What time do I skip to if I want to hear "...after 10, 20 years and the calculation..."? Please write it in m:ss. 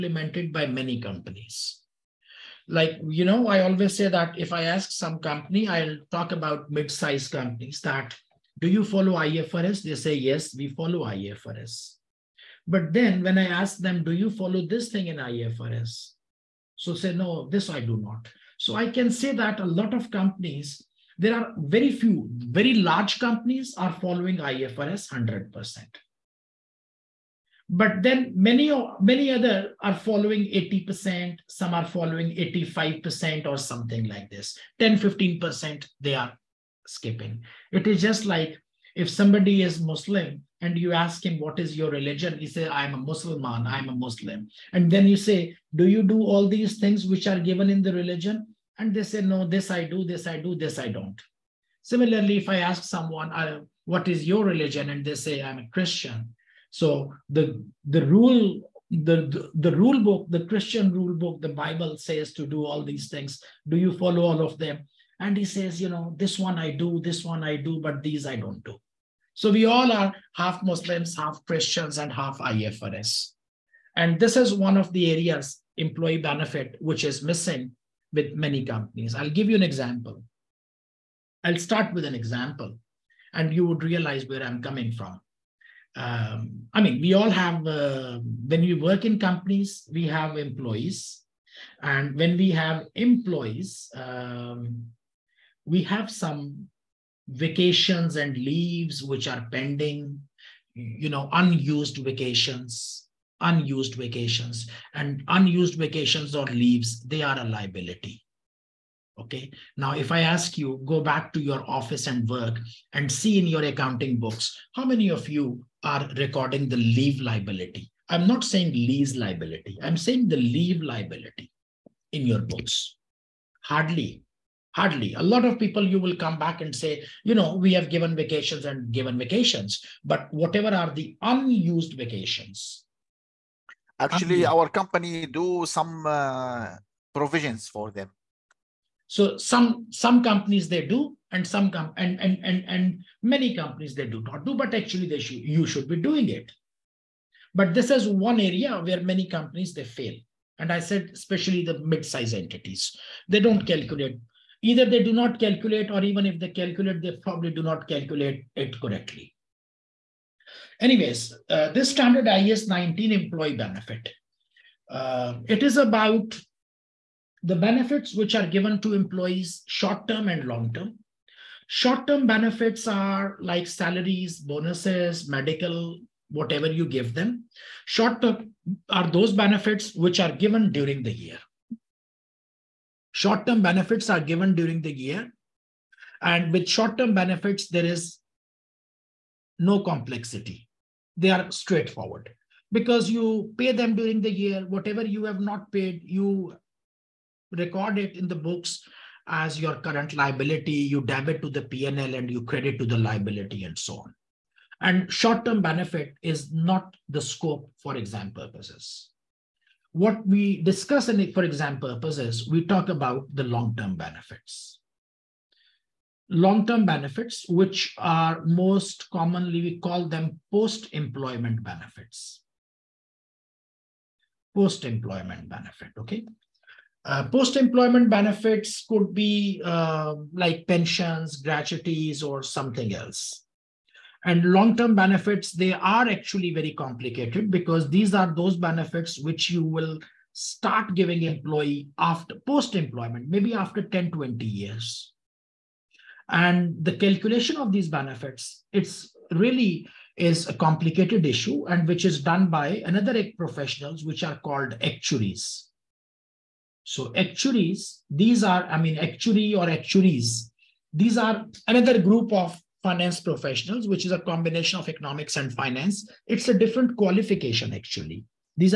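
4:03.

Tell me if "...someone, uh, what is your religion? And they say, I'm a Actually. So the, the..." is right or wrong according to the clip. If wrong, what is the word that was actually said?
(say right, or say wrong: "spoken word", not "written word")
wrong: "Christian", not "Actually".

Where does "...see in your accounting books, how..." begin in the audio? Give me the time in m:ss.
1:53.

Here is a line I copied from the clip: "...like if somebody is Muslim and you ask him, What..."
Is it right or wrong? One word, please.
right.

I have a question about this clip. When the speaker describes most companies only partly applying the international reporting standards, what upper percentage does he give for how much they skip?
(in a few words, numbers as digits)
15%.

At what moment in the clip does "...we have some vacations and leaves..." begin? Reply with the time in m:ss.
1:35.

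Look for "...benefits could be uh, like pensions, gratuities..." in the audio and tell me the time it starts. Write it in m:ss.
3:48.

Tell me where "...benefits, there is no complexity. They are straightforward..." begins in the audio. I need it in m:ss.
3:07.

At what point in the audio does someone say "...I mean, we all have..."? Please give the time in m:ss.
1:26.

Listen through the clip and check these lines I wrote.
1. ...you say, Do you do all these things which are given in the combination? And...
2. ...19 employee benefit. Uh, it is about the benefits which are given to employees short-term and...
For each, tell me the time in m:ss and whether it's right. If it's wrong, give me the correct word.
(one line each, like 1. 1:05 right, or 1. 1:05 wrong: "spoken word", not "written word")
1. 0:45 wrong: "religion", not "combination"
2. 2:42 right.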